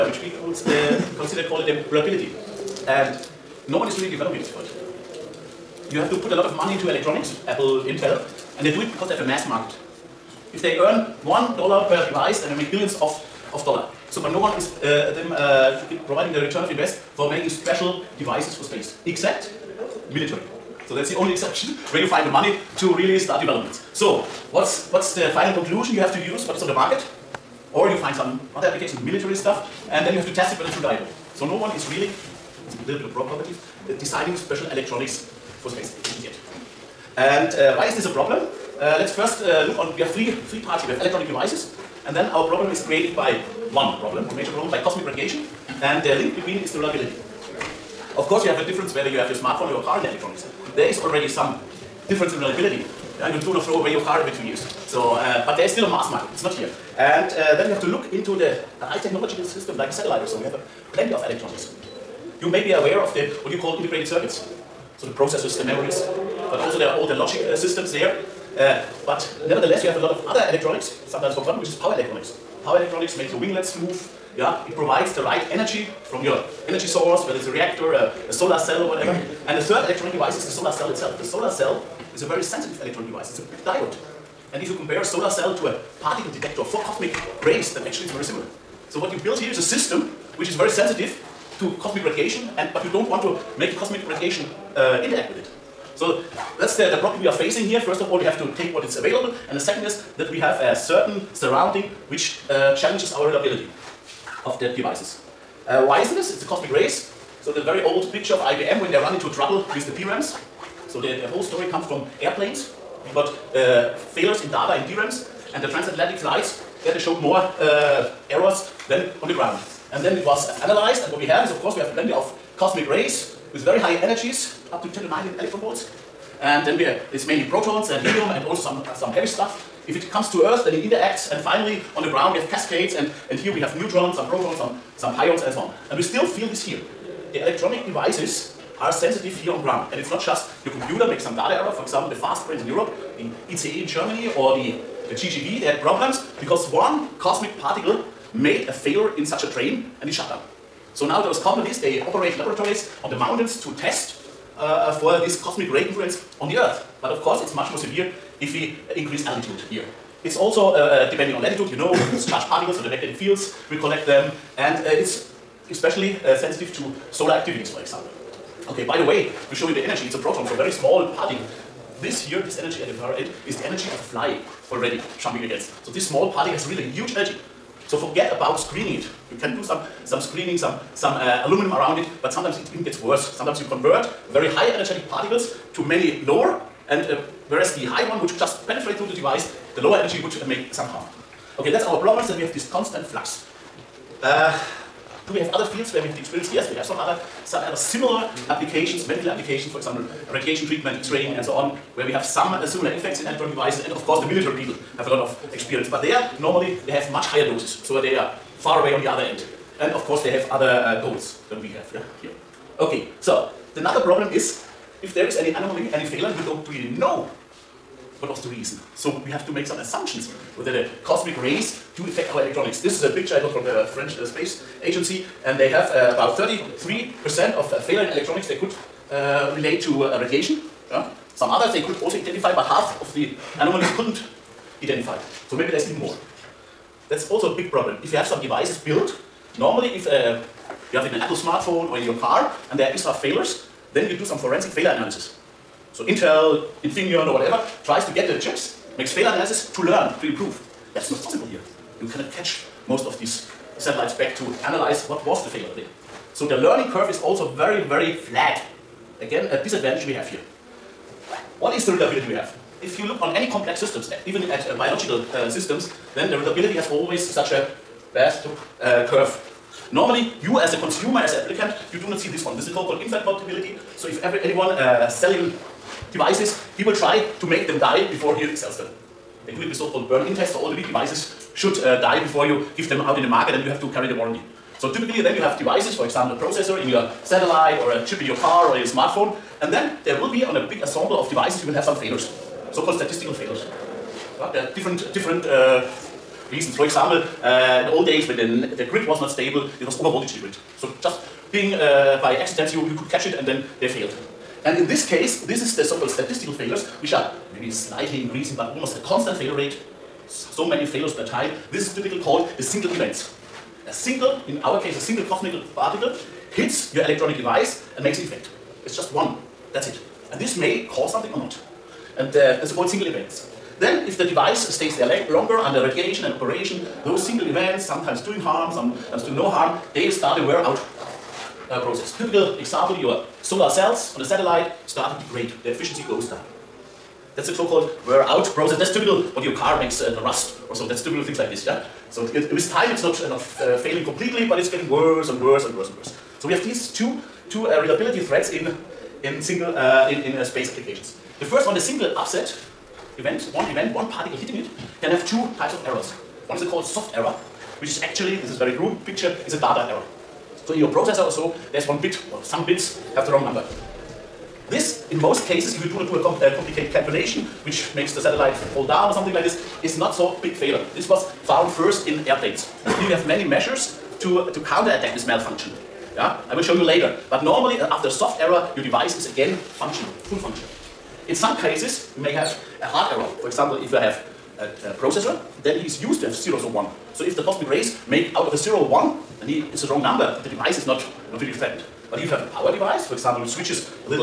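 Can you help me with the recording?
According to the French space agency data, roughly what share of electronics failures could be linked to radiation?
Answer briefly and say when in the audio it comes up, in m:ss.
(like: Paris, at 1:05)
33%, at 3:46.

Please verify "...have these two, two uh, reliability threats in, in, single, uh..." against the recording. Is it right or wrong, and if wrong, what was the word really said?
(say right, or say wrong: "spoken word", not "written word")
right.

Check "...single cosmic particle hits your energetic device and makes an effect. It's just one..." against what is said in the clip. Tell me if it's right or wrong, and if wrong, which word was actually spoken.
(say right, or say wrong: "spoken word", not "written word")
wrong: "electronic", not "energetic".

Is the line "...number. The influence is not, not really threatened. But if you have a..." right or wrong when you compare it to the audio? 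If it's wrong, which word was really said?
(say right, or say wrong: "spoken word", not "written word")
wrong: "device", not "influence".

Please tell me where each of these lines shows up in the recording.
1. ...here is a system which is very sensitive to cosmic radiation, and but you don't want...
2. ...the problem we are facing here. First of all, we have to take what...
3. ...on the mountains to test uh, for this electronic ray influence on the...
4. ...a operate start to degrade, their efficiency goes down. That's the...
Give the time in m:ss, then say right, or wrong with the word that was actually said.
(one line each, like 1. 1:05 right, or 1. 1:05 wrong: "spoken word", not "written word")
1. 1:29 right
2. 1:36 right
3. 2:33 wrong: "cosmic", not "electronic"
4. 5:34 wrong: "satellite", not "operate".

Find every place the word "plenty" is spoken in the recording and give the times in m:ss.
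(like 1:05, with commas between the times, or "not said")
1:00, 2:01.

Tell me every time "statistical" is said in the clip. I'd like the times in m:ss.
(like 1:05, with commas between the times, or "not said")
4:52, 5:06.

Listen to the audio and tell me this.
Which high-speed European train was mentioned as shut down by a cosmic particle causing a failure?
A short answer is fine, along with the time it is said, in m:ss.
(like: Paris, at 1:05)
ICE, at 2:23.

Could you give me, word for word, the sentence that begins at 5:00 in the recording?
So just being uh, by accident, you, you could catch it and then they failed.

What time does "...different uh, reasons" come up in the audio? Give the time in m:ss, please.
4:55.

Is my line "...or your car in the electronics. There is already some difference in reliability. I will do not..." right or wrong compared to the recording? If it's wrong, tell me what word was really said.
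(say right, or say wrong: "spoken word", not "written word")
right.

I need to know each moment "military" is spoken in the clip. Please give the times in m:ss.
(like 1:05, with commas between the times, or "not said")
0:20, 0:29, 3:24.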